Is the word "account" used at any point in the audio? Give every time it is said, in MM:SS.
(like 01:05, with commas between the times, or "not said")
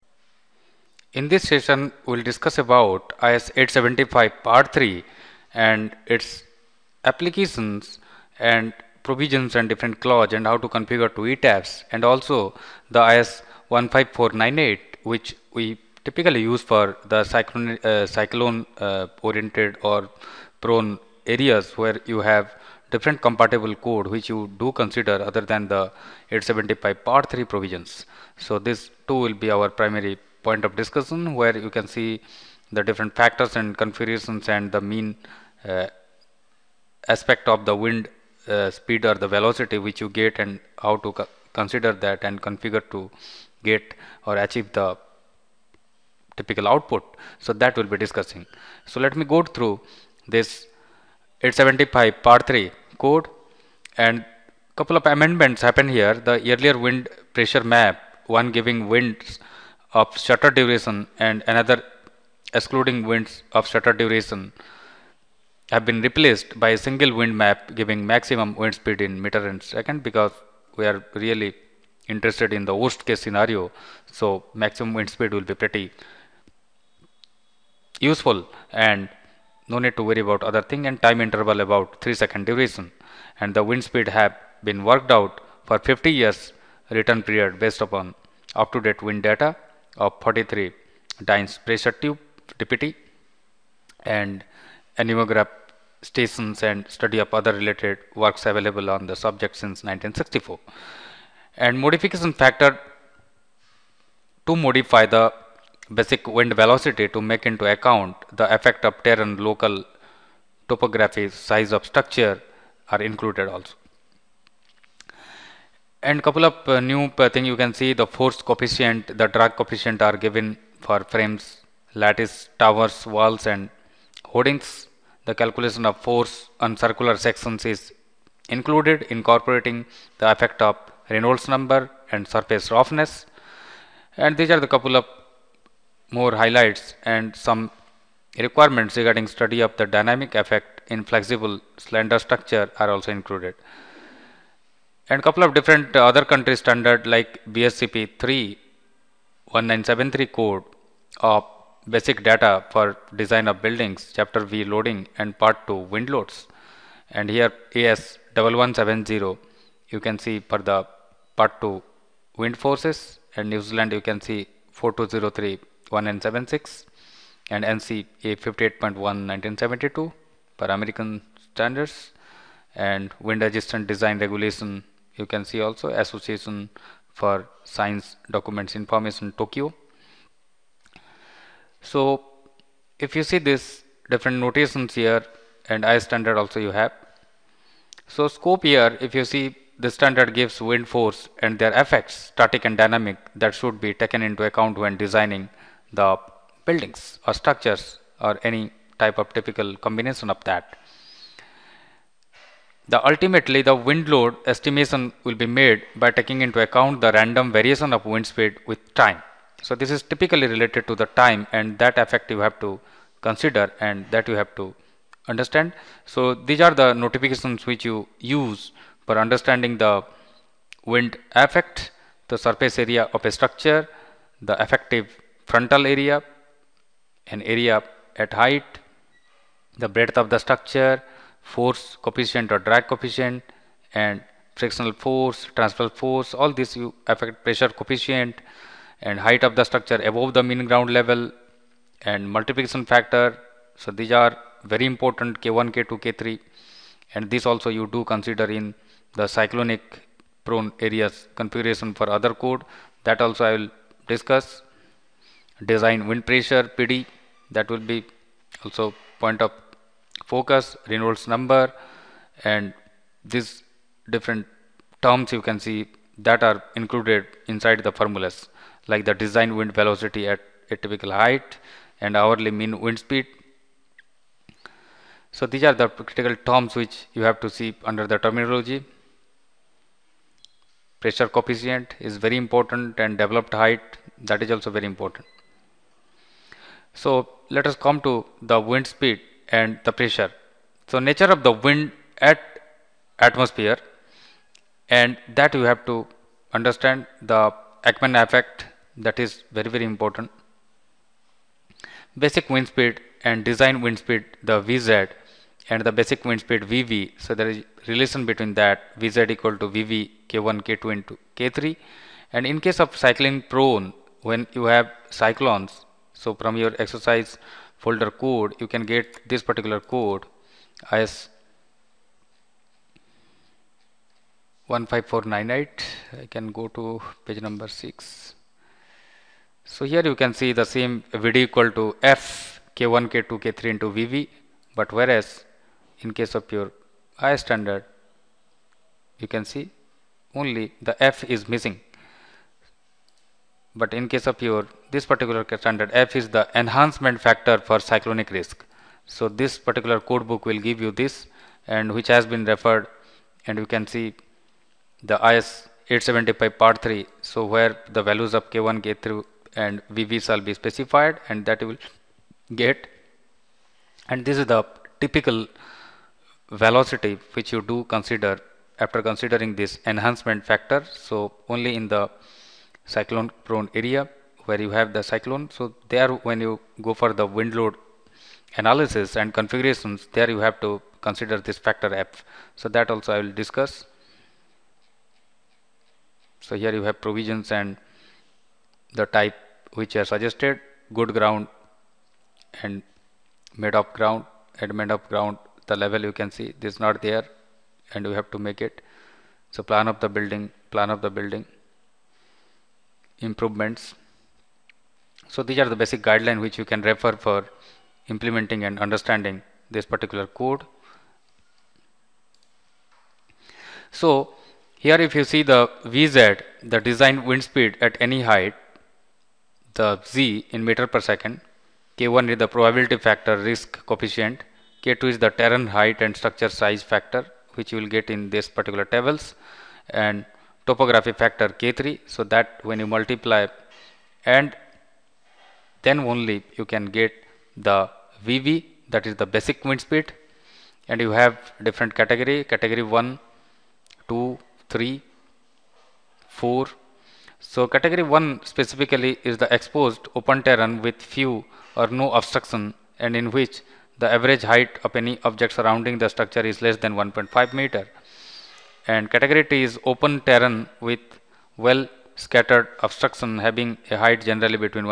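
01:47, 03:14, 03:26.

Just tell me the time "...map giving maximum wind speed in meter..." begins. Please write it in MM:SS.
01:07.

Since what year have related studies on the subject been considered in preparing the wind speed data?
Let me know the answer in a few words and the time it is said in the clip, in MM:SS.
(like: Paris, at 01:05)
1964, at 01:39.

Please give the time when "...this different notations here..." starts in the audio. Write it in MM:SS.
03:03.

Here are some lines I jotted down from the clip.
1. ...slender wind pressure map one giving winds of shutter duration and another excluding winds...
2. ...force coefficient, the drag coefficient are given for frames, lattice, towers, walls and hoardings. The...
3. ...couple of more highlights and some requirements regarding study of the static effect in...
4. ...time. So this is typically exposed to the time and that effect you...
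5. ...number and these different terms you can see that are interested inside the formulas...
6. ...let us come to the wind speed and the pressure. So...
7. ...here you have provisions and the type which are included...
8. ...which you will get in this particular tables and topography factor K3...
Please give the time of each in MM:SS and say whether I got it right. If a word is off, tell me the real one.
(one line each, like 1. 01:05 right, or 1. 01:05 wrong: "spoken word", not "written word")
1. 00:56 wrong: "earlier", not "slender"
2. 01:58 right
3. 02:14 wrong: "dynamic", not "static"
4. 03:28 wrong: "related", not "exposed"
5. 04:21 wrong: "included", not "interested"
6. 04:47 right
7. 06:26 wrong: "suggested", not "included"
8. 07:07 right.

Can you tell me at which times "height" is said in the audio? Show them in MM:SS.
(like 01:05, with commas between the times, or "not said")
03:48, 03:59, 04:31, 04:43, 06:58, 07:05, 07:34, 07:44.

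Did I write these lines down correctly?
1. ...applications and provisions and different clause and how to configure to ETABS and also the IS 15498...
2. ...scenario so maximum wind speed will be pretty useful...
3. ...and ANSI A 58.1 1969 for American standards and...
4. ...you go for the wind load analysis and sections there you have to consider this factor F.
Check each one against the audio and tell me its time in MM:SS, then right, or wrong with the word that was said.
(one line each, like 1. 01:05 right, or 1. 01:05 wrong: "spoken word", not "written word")
1. 00:07 right
2. 01:13 right
3. 02:47 wrong: "1972", not "1969"
4. 06:16 wrong: "configurations", not "sections".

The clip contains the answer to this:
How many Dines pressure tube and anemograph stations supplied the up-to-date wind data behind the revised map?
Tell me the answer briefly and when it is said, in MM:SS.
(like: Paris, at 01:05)
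43, at 01:30.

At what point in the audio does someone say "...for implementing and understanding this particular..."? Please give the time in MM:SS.
06:47.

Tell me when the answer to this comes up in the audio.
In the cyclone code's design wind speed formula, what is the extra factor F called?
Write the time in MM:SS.
05:46.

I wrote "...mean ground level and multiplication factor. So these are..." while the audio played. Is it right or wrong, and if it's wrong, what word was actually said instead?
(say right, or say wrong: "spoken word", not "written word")
right.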